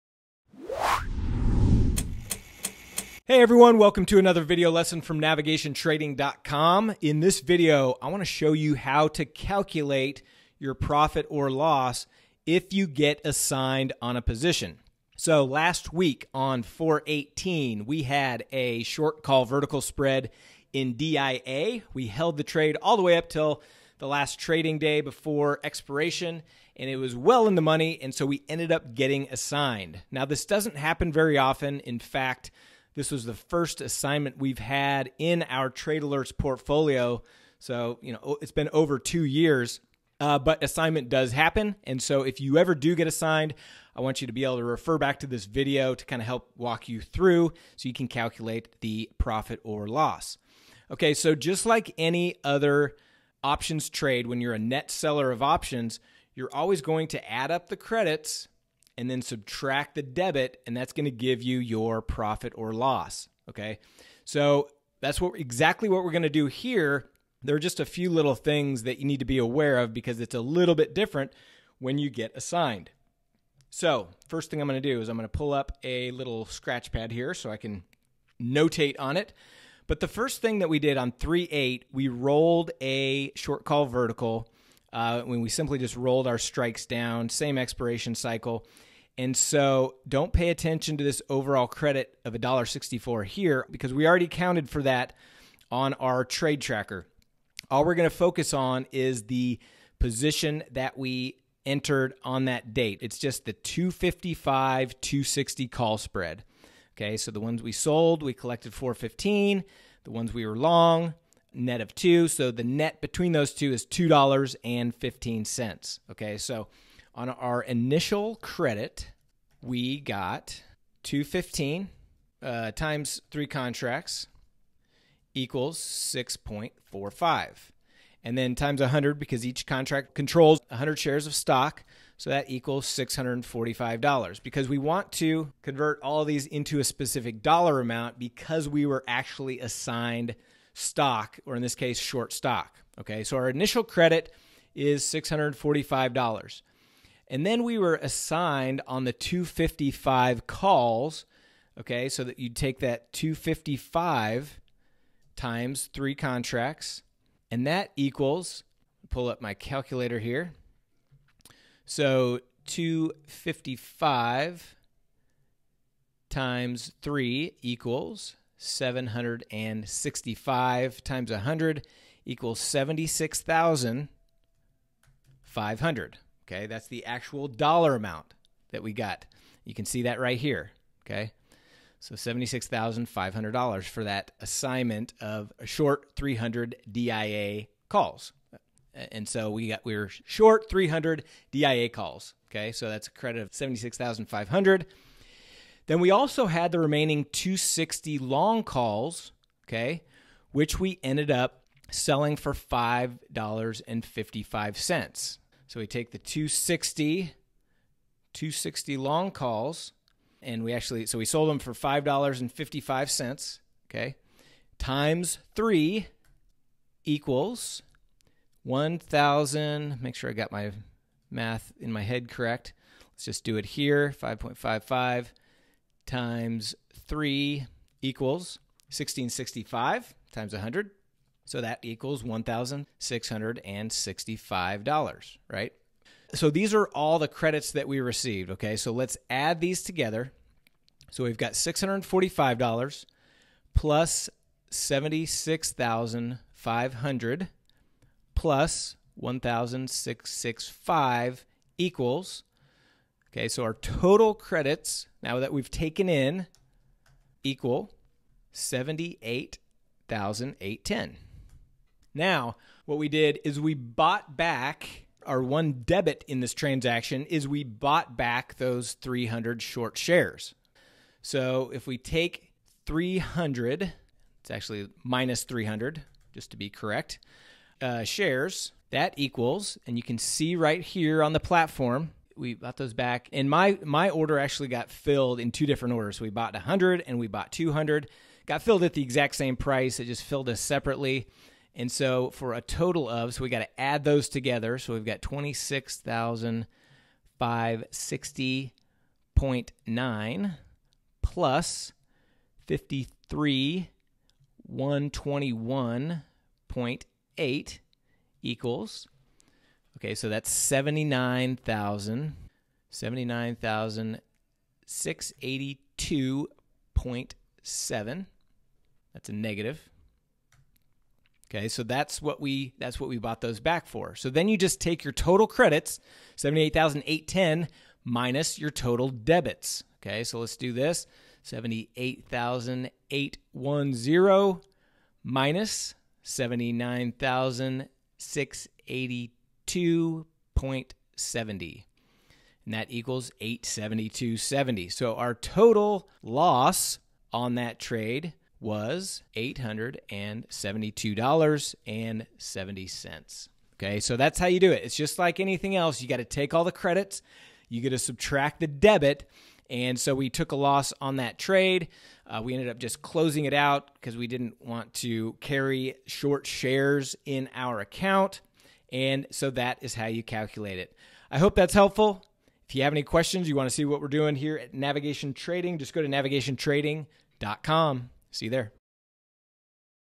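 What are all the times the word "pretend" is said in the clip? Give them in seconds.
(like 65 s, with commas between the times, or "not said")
not said.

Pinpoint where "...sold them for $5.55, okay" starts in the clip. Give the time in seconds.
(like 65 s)
211 s.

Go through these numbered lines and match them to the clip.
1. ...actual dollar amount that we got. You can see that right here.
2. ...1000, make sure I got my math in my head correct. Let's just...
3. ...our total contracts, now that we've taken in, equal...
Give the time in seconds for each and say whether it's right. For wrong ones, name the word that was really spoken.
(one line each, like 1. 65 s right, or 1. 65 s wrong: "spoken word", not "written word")
1. 177 s right
2. 218 s right
3. 253 s wrong: "credits", not "contracts".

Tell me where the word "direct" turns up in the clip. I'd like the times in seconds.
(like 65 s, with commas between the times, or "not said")
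not said.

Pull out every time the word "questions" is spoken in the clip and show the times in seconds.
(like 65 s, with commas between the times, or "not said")
373 s.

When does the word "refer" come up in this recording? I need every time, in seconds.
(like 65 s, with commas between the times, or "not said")
44 s.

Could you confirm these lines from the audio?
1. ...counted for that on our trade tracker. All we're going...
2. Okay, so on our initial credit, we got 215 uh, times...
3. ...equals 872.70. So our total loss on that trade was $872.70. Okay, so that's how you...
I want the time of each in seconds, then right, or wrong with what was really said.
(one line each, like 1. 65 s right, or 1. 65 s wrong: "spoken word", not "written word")
1. 94 s right
2. 116 s right
3. 342 s right.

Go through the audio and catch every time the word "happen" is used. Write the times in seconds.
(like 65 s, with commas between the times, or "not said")
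30 s, 41 s.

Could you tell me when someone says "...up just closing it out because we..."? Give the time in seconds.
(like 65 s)
362 s.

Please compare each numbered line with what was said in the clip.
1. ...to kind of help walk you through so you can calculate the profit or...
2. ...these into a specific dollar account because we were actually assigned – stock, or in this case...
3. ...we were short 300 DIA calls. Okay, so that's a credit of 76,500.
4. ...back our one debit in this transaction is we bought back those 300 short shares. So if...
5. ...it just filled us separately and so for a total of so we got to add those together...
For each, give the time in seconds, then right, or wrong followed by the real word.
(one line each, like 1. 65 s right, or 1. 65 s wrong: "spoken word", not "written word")
1. 45 s right
2. 136 s wrong: "amount", not "account"
3. 189 s right
4. 264 s right
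5. 289 s right.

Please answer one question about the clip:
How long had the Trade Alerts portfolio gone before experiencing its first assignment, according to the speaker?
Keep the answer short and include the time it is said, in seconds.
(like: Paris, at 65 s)
over two years, at 38 s.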